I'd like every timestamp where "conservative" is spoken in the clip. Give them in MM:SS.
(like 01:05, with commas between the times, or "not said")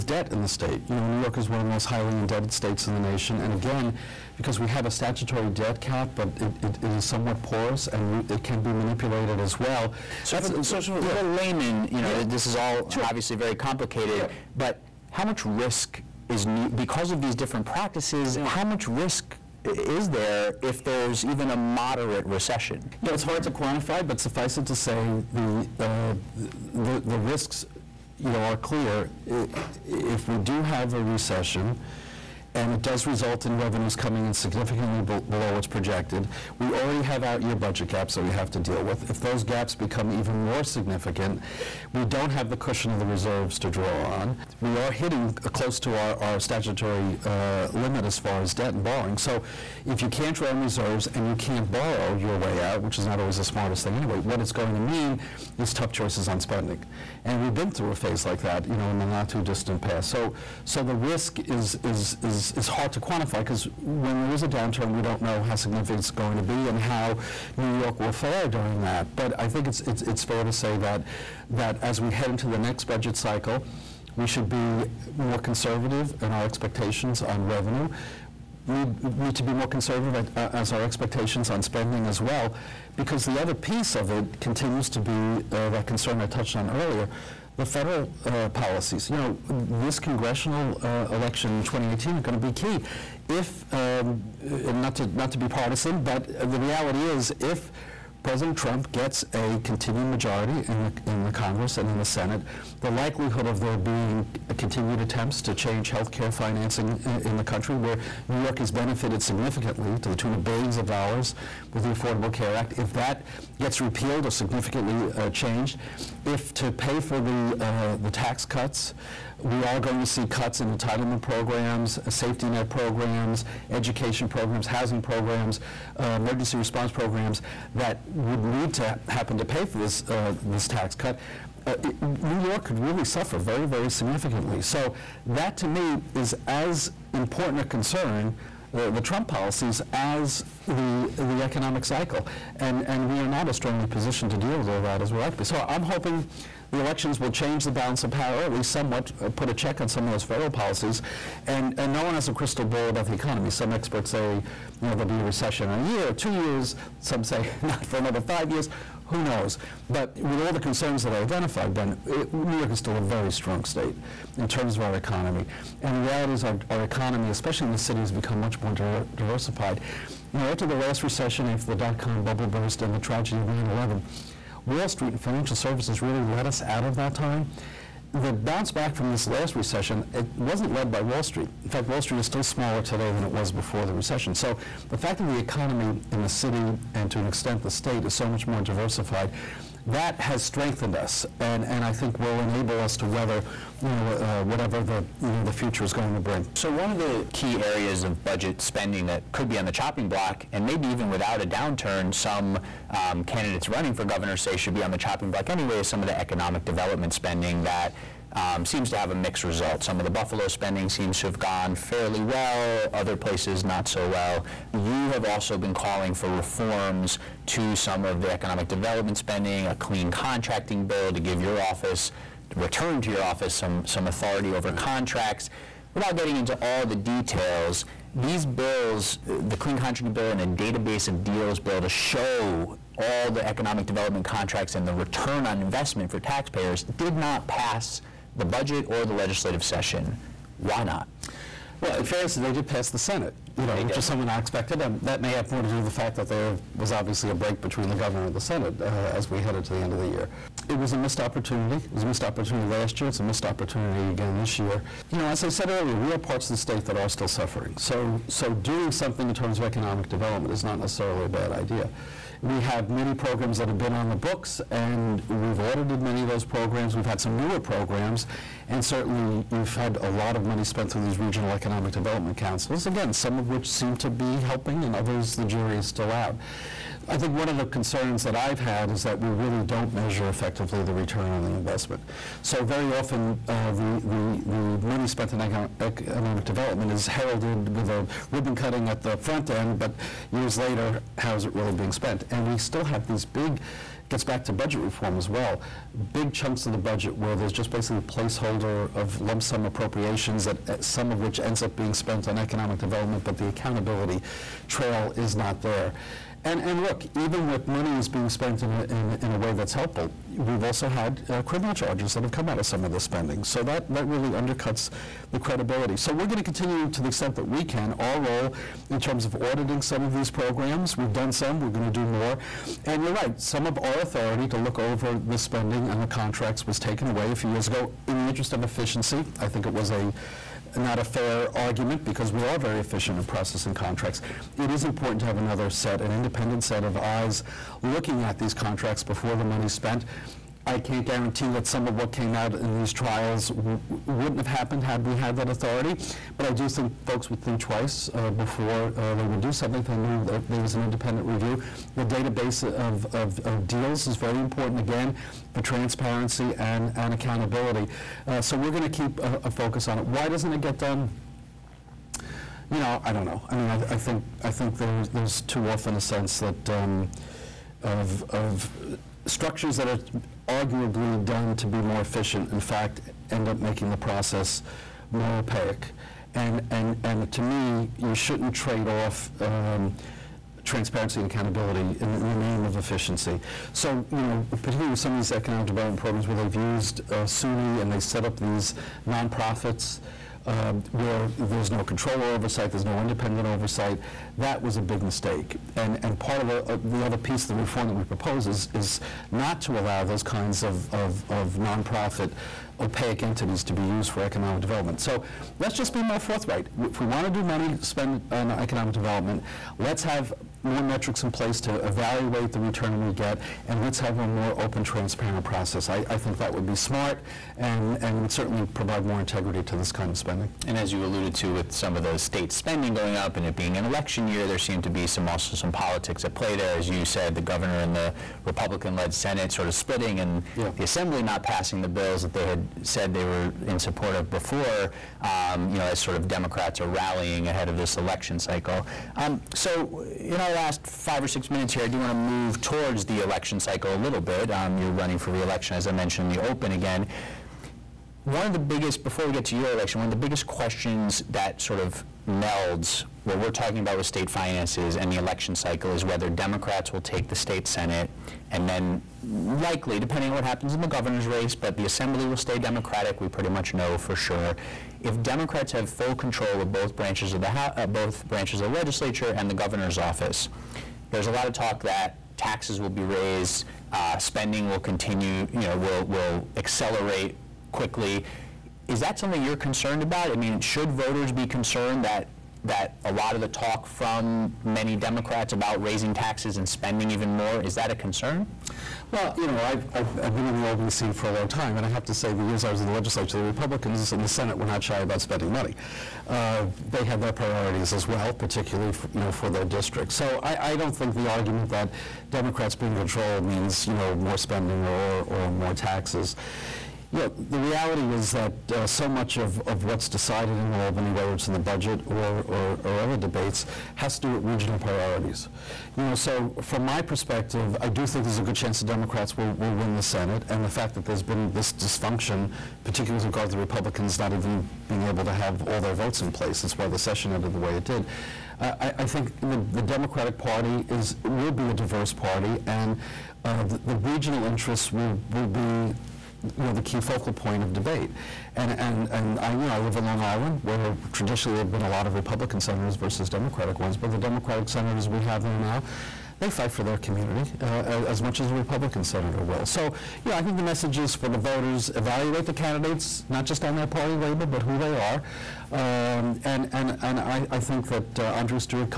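01:15, 01:19.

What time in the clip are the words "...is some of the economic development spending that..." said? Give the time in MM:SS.
03:25.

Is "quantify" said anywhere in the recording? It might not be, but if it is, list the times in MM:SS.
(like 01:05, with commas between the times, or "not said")
00:23, 01:03.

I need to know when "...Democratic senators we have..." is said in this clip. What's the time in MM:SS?
09:04.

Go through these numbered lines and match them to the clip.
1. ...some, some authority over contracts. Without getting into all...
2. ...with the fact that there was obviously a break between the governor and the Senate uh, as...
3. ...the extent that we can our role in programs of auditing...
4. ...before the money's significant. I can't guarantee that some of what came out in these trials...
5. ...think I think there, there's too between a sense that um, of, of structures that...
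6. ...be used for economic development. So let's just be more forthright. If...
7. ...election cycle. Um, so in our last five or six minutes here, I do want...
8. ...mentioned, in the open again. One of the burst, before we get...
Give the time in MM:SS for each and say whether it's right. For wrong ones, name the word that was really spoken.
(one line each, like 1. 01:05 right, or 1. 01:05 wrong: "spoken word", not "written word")
1. 03:43 right
2. 04:05 right
3. 05:17 wrong: "terms", not "programs"
4. 05:39 wrong: "spent", not "significant"
5. 06:03 wrong: "often", not "between"
6. 06:43 right
7. 07:17 right
8. 07:25 wrong: "biggest", not "burst".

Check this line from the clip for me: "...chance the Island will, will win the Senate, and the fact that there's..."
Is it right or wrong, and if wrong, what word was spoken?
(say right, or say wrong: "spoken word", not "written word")
wrong: "Democrats", not "Island".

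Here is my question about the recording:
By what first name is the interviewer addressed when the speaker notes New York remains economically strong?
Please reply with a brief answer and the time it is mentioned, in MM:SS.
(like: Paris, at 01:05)
Ben, at 02:41.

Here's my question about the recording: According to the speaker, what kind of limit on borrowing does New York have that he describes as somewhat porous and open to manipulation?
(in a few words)
statutory debt cap.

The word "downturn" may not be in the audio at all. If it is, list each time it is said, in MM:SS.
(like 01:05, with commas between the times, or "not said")
01:04, 03:21.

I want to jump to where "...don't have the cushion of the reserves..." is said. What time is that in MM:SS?
00:42.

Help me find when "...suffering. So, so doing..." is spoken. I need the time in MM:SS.
04:17.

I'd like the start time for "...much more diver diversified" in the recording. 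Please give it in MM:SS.
02:48.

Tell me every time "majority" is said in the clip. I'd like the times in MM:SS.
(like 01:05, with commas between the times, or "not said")
01:40.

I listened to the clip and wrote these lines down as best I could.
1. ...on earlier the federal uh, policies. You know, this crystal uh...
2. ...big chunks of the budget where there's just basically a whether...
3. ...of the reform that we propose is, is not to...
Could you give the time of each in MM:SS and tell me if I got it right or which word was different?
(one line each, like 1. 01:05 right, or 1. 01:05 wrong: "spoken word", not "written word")
1. 01:26 wrong: "congressional", not "crystal"
2. 04:56 wrong: "placeholder", not "whether"
3. 06:37 right.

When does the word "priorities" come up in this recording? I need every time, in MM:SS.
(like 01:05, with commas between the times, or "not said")
08:17, 08:34.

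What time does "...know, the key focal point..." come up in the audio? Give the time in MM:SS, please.
08:56.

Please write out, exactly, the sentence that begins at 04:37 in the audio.
I think one of the concerns that I've had is that we really don't measure effectively the return on the investment.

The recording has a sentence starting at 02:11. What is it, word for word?
Uh, it, New York could really suffer very, very significantly.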